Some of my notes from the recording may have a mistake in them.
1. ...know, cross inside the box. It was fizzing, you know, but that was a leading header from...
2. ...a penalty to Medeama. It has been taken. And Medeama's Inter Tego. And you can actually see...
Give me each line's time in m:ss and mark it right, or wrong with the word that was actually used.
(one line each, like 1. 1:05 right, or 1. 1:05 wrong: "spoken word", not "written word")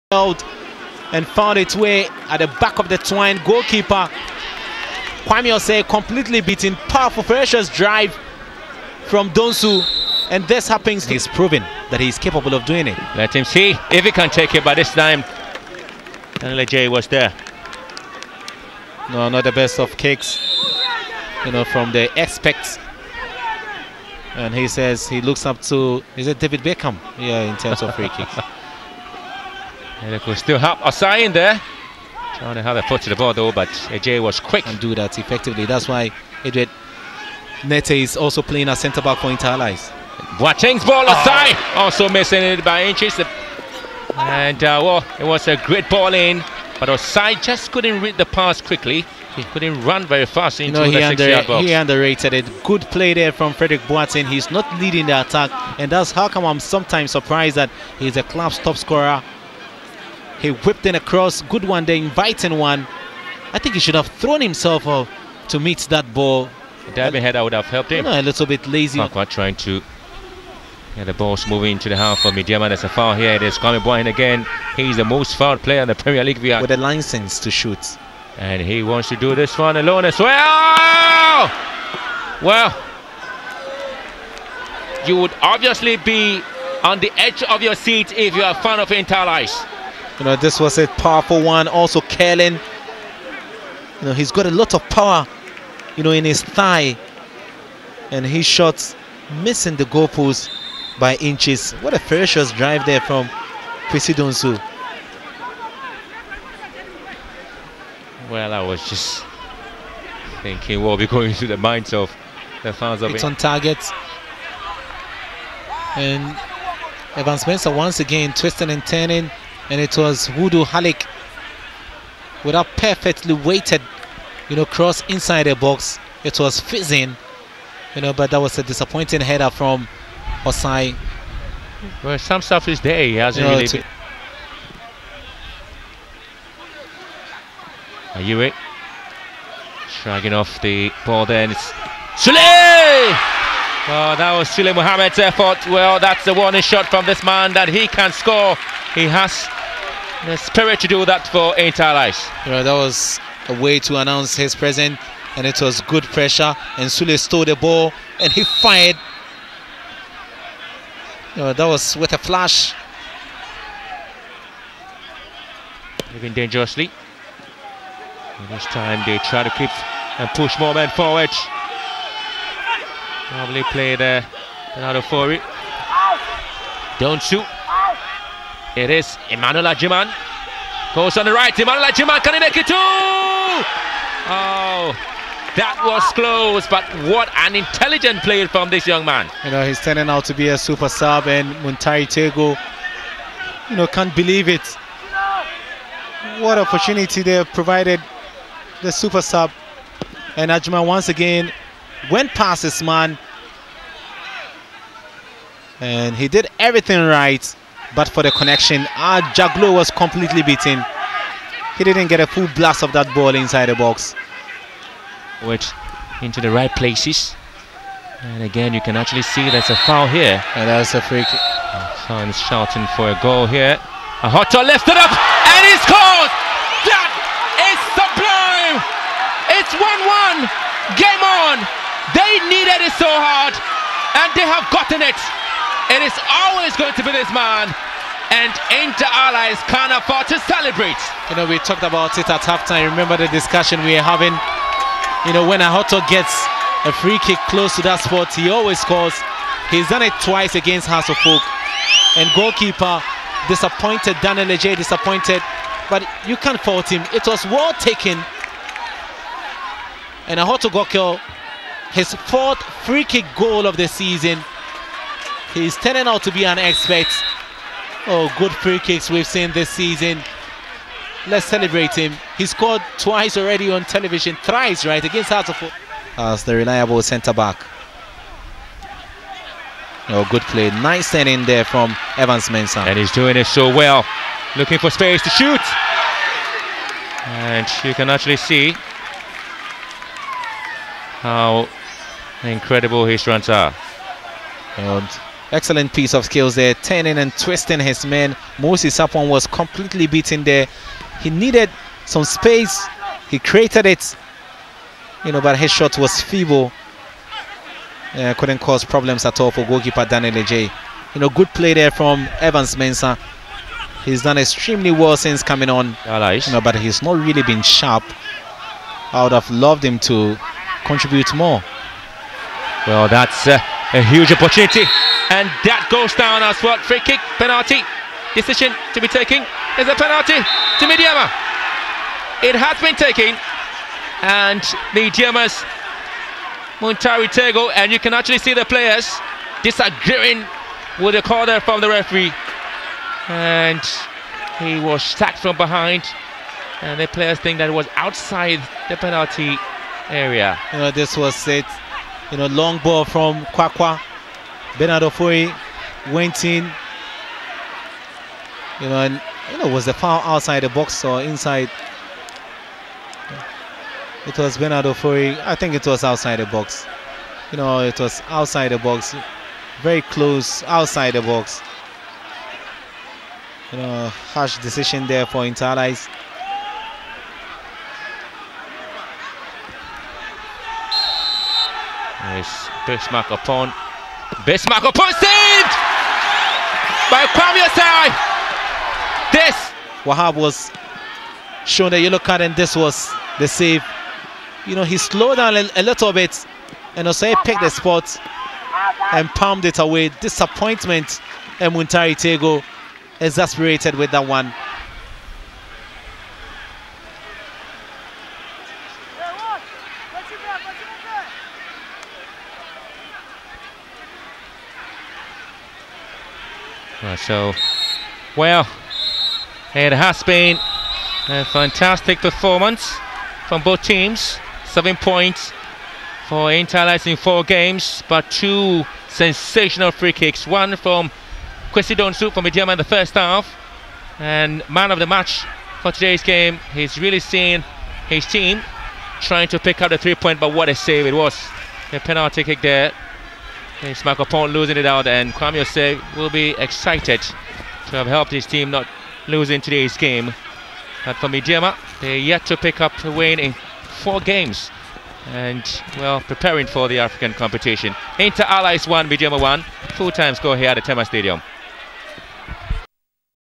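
1. 2:04 wrong: "disappointing", not "leading"
2. 5:29 wrong: "Montari", not "Inter".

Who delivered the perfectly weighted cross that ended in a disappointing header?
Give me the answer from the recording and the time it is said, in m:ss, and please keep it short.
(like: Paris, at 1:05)
Wudu Halik, at 2:00.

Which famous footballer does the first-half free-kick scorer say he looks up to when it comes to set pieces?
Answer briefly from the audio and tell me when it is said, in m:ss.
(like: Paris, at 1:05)
David Beckham, at 0:26.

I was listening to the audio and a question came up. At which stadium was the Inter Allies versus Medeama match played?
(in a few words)
Tema Stadium.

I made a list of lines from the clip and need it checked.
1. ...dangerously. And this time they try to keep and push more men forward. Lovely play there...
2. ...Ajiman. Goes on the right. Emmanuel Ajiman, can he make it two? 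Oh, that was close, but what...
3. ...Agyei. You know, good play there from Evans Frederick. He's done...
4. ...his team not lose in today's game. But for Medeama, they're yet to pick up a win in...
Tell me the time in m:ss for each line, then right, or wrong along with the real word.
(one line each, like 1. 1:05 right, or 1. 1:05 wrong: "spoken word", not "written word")
1. 2:46 right
2. 2:59 right
3. 5:10 wrong: "Mensah", not "Frederick"
4. 7:28 right.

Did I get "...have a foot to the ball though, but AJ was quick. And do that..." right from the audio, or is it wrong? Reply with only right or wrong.
right.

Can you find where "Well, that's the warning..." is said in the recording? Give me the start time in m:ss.
2:25.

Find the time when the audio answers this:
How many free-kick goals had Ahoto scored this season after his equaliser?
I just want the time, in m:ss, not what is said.
4:22.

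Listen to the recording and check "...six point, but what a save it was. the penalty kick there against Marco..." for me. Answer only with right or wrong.
wrong.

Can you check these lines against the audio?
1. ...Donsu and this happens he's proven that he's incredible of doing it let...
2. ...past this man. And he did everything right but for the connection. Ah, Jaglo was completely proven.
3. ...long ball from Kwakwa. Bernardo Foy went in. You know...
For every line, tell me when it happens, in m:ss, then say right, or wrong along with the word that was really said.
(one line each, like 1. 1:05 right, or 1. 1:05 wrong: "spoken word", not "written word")
1. 0:09 wrong: "capable", not "incredible"
2. 3:22 wrong: "beaten", not "proven"
3. 5:52 right.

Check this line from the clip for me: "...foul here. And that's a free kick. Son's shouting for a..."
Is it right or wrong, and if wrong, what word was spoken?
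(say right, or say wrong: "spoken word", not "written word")
right.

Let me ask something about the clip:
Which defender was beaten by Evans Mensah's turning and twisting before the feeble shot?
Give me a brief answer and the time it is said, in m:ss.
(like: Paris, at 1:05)
Moses Sapon, at 4:58.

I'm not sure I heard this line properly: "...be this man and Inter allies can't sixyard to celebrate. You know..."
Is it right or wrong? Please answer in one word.
wrong.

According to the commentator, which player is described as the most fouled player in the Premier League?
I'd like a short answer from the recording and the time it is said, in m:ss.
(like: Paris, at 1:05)
Kwame Boyne, at 1:13.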